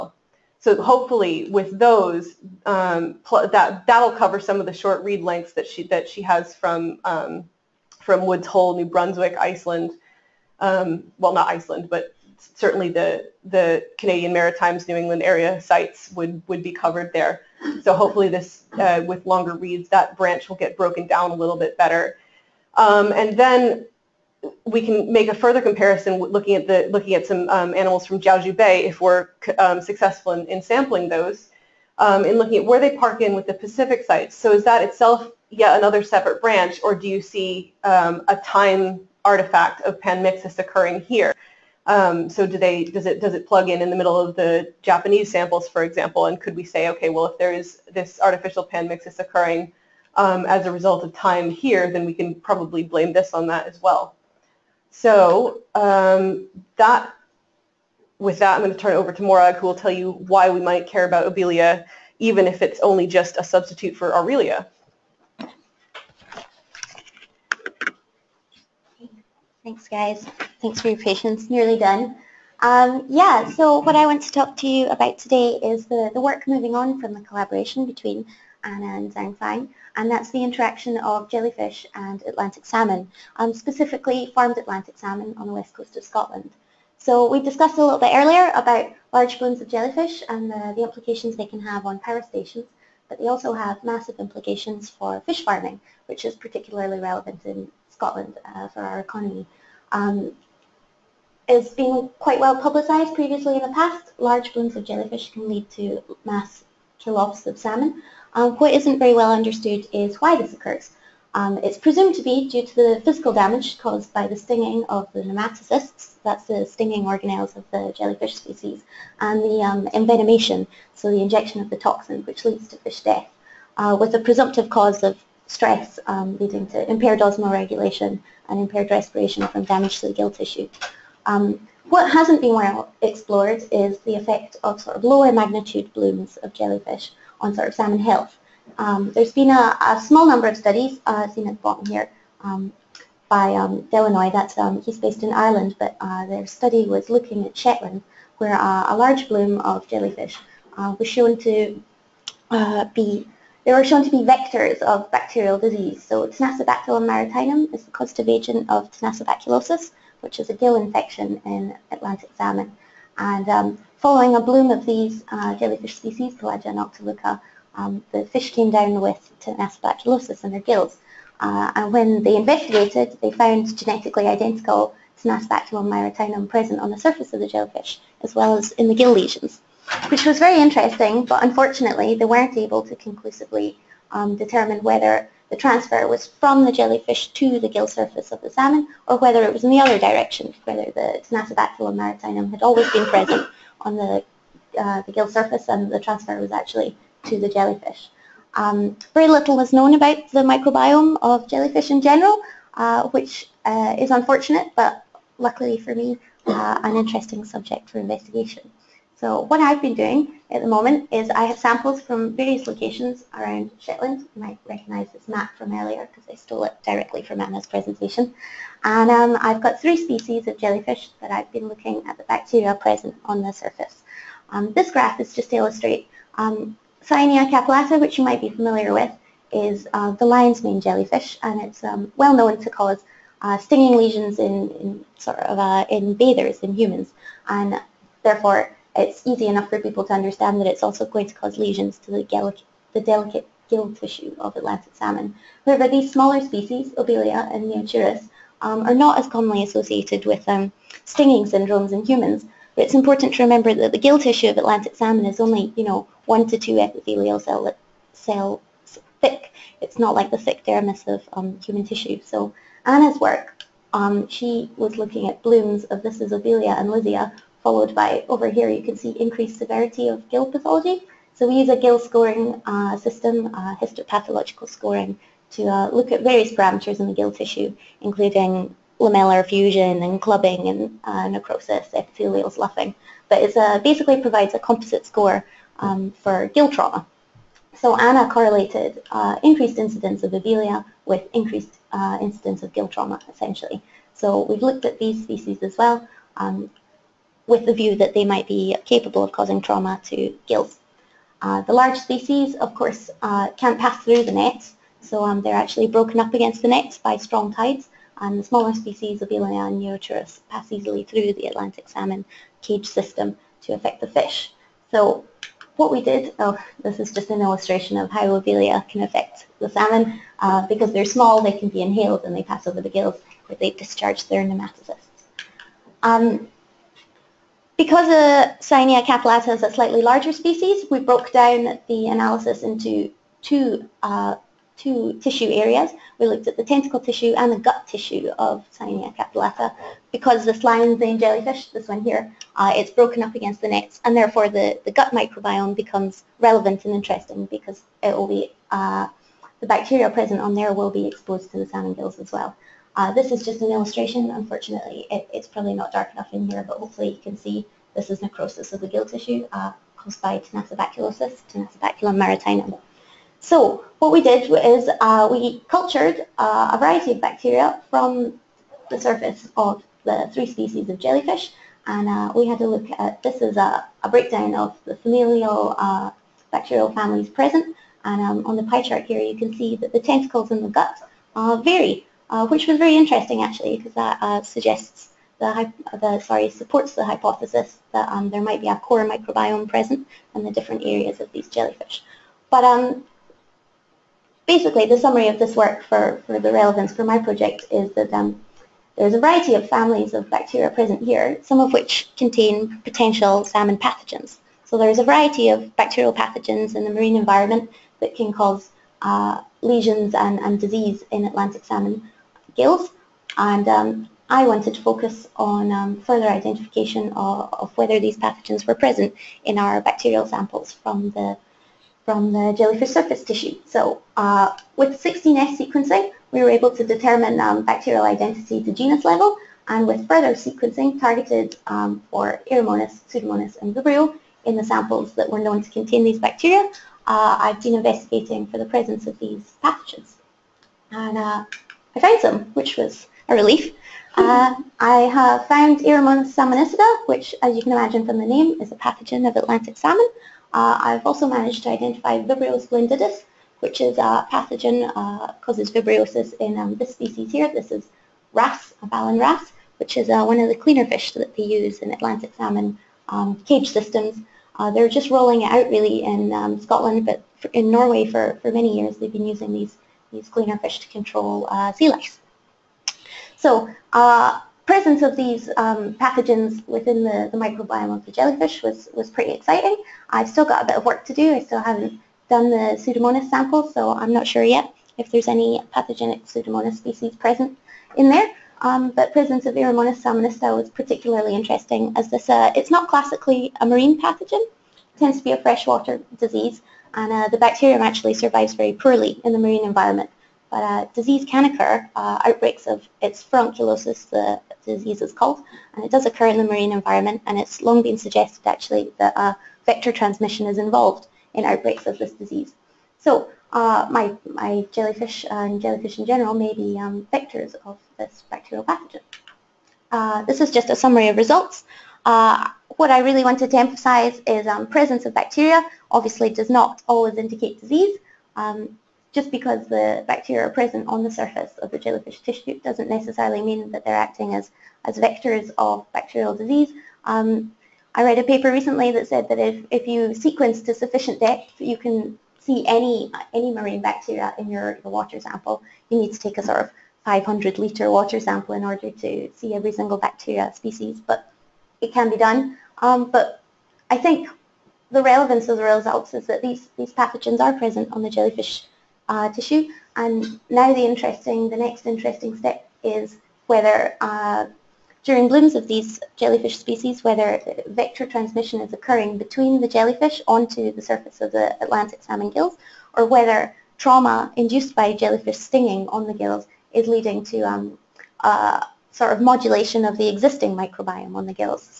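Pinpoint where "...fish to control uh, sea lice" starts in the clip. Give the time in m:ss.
7:50.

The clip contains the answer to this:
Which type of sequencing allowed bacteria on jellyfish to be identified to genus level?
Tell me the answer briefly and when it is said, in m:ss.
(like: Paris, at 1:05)
16S sequencing, at 7:05.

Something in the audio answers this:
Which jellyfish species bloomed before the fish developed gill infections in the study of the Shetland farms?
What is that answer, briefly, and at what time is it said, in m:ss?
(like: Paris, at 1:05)
Pelagia noctiluca, at 2:46.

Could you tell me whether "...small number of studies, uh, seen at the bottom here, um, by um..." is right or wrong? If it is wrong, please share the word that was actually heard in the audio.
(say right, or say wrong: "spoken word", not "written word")
right.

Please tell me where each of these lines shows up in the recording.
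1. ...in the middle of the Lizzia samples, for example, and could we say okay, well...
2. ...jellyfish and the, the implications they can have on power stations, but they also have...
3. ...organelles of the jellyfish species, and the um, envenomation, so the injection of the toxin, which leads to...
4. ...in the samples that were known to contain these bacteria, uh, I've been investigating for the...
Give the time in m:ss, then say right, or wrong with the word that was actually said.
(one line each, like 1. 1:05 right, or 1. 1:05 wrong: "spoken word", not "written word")
1. 0:43 wrong: "Japanese", not "Lizzia"
2. 1:29 right
3. 1:57 right
4. 7:14 right.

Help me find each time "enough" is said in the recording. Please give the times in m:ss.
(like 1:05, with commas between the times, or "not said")
3:59, 5:56.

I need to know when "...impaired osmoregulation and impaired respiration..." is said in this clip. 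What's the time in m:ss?
2:06.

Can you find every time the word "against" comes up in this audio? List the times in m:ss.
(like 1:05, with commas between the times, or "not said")
5:06, 5:43.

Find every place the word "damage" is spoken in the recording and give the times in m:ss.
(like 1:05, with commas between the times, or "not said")
1:53, 2:09.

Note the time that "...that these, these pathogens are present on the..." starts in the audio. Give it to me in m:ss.
9:16.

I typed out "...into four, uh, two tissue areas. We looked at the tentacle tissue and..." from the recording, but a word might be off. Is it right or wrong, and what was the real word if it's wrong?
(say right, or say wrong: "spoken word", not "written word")
wrong: "two", not "four".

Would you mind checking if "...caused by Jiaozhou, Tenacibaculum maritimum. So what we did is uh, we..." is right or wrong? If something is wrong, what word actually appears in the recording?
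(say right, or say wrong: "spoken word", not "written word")
wrong: "Tenacibaculosis", not "Jiaozhou".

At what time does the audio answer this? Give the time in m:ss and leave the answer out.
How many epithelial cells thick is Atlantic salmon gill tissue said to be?
4:16.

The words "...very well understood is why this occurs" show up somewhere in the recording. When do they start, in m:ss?
1:48.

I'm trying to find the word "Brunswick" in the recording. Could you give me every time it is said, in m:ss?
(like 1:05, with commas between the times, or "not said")
0:08.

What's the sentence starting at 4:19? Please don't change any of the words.
It's not like the thick dermis of um, human tissue.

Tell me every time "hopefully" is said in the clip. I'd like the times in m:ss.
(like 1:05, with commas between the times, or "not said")
0:00, 0:17, 5:56.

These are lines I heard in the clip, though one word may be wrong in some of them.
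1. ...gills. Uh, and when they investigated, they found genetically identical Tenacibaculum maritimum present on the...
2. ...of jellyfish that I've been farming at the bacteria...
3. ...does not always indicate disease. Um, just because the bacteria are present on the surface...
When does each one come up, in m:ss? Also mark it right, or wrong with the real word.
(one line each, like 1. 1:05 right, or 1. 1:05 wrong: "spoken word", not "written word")
1. 2:50 right
2. 3:40 wrong: "looking", not "farming"
3. 8:46 right.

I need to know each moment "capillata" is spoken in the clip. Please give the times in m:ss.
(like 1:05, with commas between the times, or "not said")
3:47, 5:29, 5:39.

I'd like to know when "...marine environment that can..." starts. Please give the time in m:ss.
6:46.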